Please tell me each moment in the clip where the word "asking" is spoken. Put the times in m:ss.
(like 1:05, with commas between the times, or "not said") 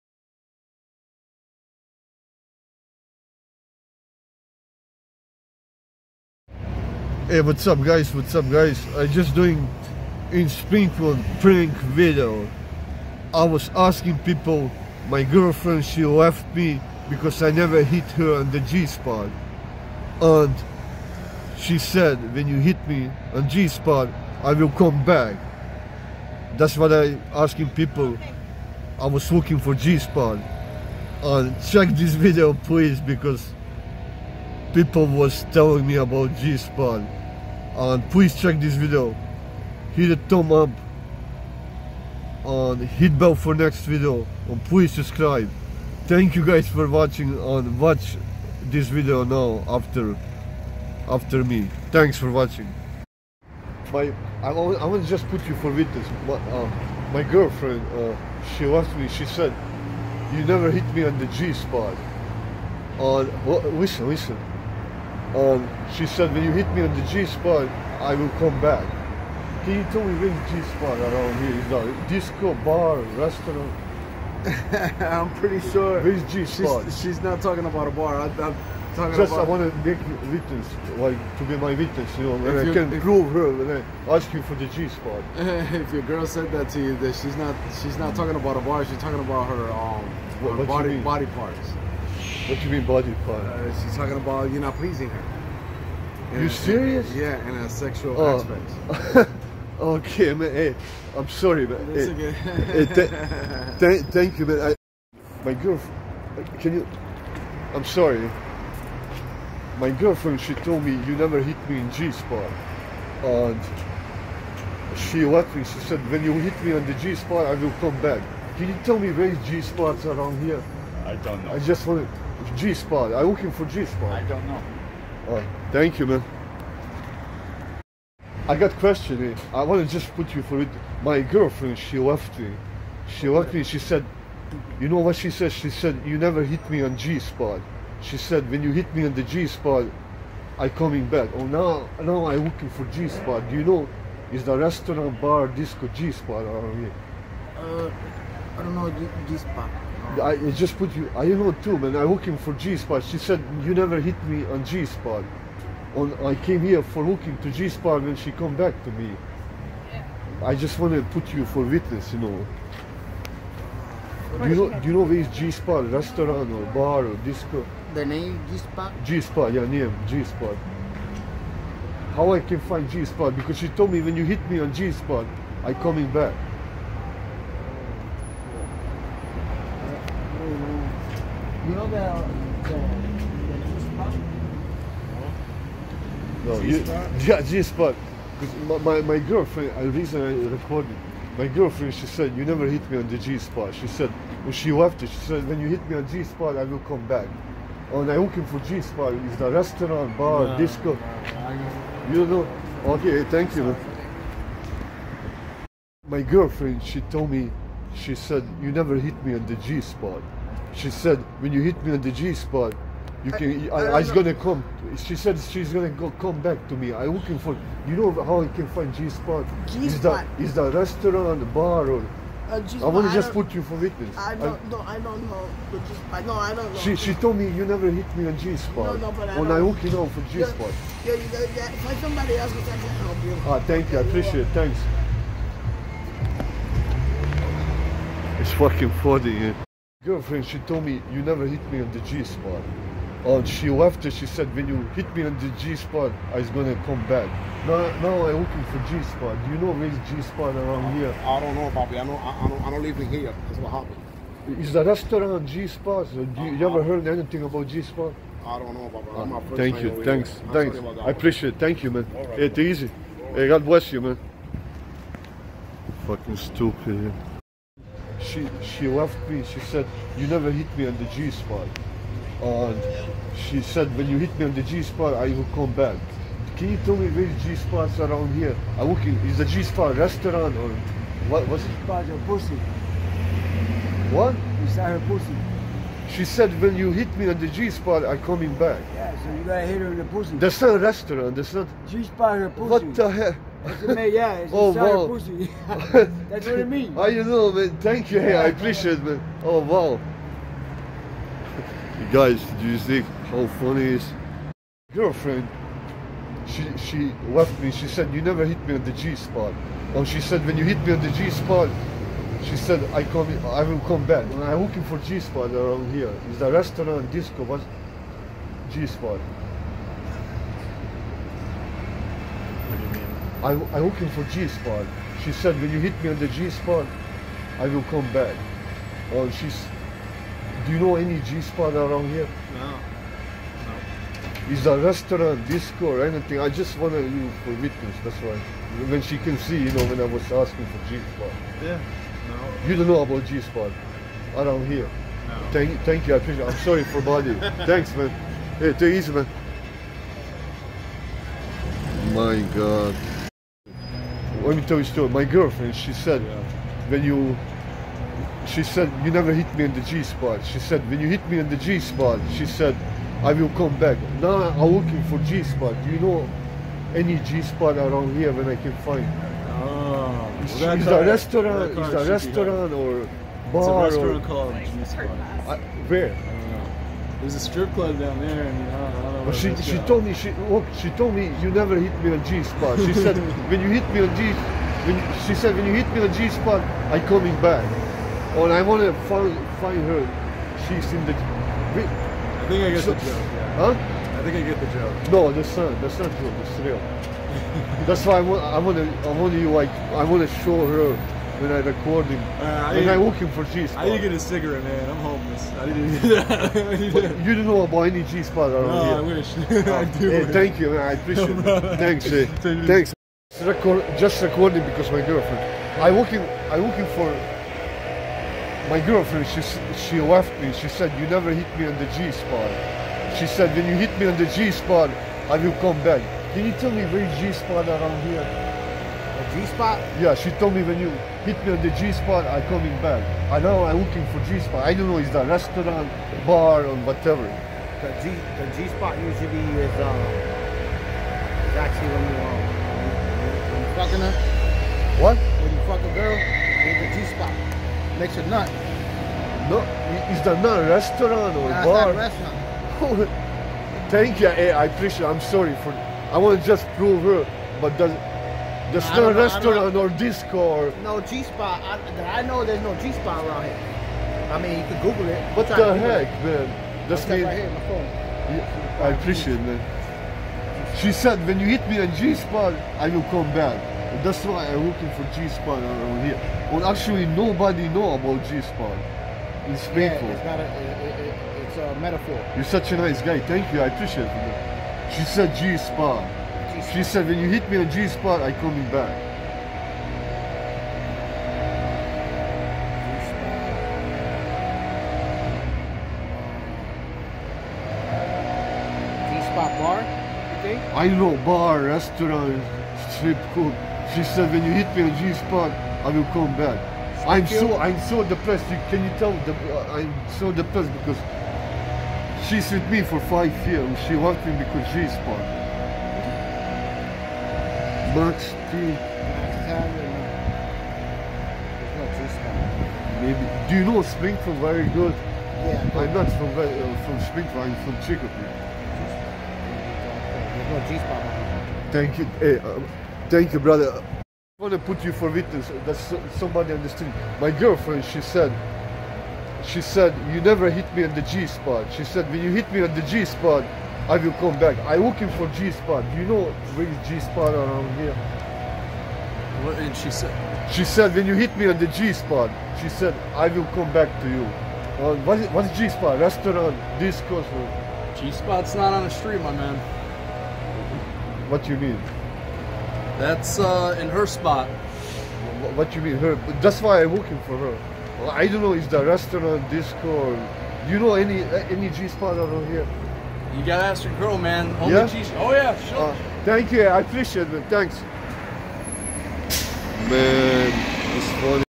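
0:13, 0:27, 5:40.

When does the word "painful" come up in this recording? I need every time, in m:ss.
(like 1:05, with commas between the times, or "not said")
7:59.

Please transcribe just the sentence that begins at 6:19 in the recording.
But she she told me she look oh, she told me you never hit me on G spot.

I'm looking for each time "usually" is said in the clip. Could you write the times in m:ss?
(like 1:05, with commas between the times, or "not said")
7:18.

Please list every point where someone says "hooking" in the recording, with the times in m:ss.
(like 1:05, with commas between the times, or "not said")
2:32, 2:37.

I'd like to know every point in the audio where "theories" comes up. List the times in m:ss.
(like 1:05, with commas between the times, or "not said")
not said.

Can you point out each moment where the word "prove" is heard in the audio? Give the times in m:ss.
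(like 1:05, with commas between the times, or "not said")
1:23, 7:36.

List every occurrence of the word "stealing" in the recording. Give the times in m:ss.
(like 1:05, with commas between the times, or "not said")
not said.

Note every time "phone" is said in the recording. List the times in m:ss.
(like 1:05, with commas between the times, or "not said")
7:47.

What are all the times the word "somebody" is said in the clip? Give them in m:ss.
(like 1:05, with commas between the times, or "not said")
3:51, 8:56.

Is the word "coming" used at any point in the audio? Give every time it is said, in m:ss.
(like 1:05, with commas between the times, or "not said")
2:20, 2:55, 4:48, 6:27, 7:12, 8:08.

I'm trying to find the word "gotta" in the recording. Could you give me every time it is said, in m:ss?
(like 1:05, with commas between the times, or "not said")
4:49, 9:33.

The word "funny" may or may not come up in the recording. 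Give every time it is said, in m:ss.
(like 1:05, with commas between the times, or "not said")
3:59, 5:03, 9:41.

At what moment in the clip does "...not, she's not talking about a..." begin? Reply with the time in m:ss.
1:27.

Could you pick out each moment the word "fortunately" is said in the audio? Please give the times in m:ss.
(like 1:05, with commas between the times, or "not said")
not said.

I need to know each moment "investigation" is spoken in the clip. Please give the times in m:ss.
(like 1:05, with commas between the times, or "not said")
not said.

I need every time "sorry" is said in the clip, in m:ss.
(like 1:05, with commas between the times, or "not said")
1:41, 1:47, 5:46, 7:35.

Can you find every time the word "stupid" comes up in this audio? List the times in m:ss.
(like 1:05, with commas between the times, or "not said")
4:26.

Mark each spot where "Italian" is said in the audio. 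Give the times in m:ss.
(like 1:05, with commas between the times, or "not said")
not said.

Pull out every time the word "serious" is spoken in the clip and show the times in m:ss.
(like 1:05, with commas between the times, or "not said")
1:36.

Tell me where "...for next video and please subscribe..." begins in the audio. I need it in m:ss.
0:43.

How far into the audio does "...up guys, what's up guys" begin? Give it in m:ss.
0:07.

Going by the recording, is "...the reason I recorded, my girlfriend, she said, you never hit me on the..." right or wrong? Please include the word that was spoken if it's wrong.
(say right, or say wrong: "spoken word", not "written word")
right.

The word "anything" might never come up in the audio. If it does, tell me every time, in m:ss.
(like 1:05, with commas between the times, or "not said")
4:17, 5:36.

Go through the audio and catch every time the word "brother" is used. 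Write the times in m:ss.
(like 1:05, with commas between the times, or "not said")
8:53.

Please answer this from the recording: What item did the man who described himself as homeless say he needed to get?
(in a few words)
A cigarette.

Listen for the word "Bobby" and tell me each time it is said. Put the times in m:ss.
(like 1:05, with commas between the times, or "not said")
4:11, 4:18.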